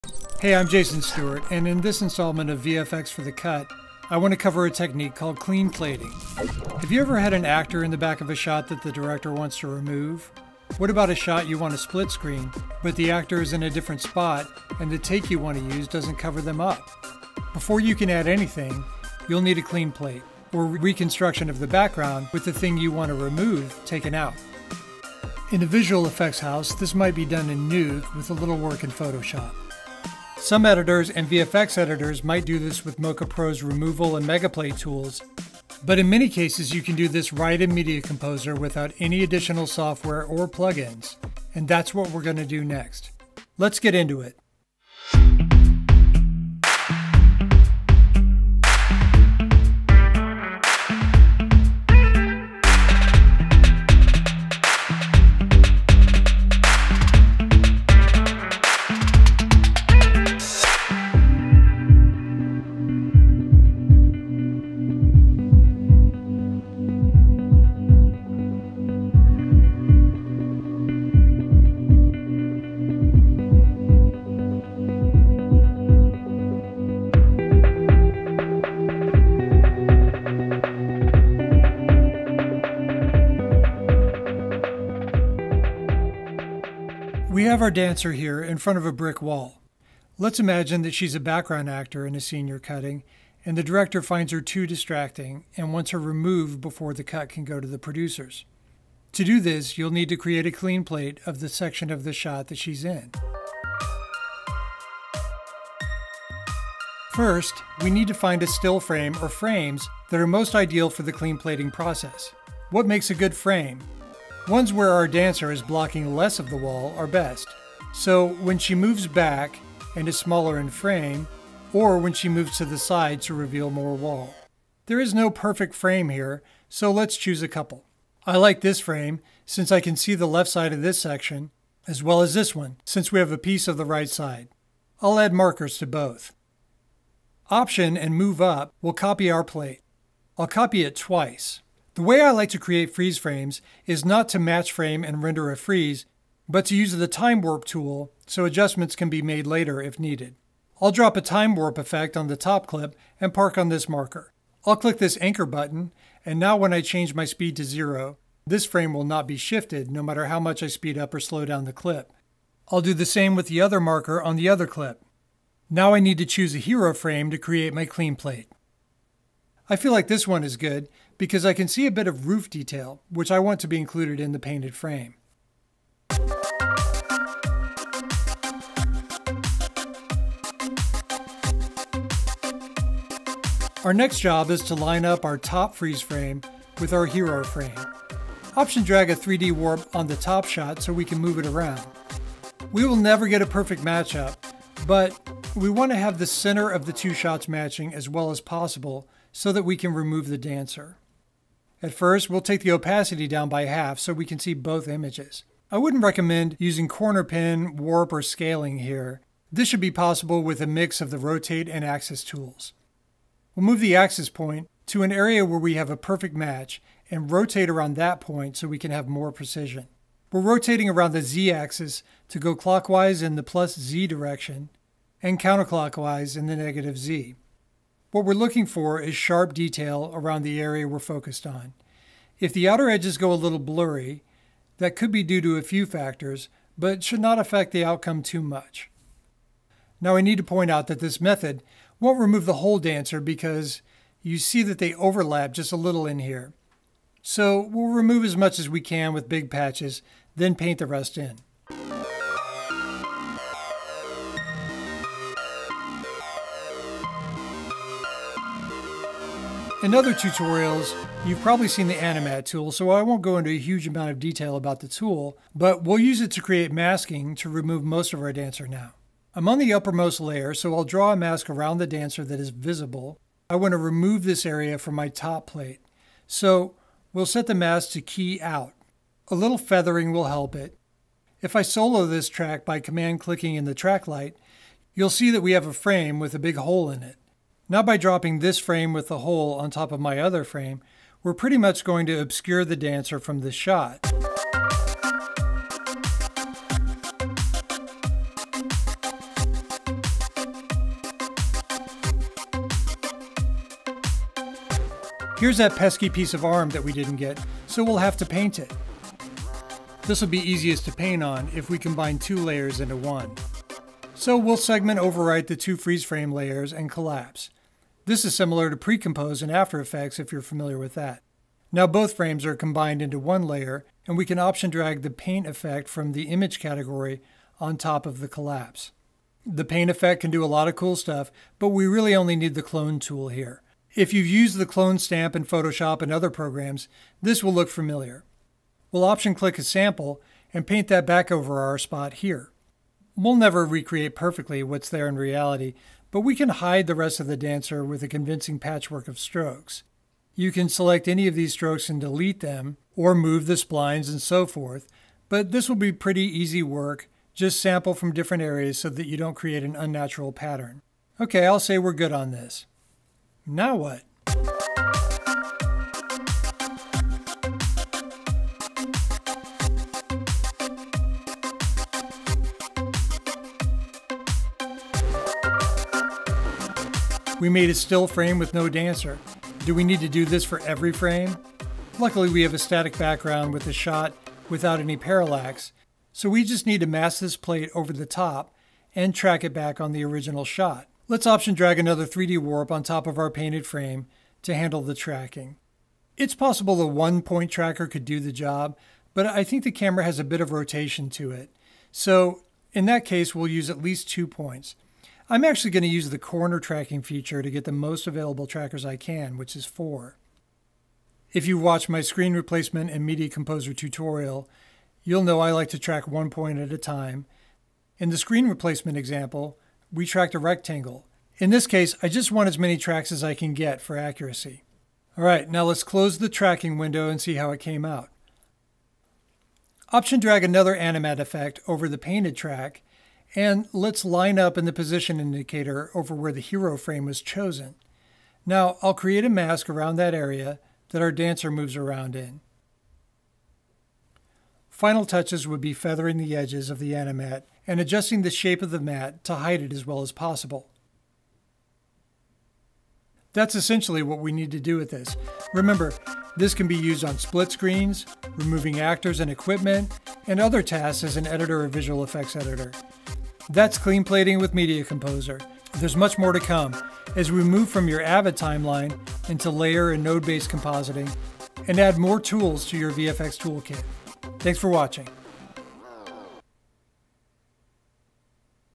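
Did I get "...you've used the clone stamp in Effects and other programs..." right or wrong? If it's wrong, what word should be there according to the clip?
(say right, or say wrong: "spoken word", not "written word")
wrong: "Photoshop", not "Effects".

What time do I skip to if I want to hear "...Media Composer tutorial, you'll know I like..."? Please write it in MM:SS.
06:53.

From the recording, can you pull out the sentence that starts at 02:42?
I'll do the same with the other marker on the other clip.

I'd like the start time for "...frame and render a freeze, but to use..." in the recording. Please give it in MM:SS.
02:24.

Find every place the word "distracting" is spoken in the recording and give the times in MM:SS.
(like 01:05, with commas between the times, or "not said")
01:34.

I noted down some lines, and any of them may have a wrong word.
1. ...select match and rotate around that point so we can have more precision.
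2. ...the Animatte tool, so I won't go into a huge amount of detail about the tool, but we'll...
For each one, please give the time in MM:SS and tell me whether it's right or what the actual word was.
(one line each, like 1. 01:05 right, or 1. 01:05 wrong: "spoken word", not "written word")
1. 03:35 wrong: "perfect", not "select"
2. 04:21 right.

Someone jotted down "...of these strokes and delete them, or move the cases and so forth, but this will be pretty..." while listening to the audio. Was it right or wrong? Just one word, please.
wrong.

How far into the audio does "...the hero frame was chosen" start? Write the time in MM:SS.
07:16.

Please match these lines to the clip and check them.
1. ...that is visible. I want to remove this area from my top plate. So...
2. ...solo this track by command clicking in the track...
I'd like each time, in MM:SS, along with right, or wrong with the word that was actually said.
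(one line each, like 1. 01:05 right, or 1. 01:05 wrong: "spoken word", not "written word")
1. 04:32 right
2. 04:41 right.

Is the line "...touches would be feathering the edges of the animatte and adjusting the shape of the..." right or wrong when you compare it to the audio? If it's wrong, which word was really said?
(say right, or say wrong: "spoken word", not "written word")
right.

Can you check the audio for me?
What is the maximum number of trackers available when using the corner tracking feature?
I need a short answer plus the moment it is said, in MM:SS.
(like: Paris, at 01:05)
4, at 06:49.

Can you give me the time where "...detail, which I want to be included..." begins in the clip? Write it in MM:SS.
02:52.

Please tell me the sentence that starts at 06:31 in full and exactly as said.
Let's option drag another 3D warp on top of our painted frame to handle the tracking.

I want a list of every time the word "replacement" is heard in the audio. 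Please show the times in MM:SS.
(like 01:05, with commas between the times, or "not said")
06:52, 06:58.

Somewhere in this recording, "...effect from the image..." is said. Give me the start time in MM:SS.
05:25.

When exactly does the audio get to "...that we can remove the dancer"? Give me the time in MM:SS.
03:19.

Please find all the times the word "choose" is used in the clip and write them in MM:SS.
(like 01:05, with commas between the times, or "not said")
02:07, 02:46.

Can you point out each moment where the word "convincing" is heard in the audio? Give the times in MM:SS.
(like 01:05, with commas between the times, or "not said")
05:48.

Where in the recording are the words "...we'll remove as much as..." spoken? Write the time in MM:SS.
04:07.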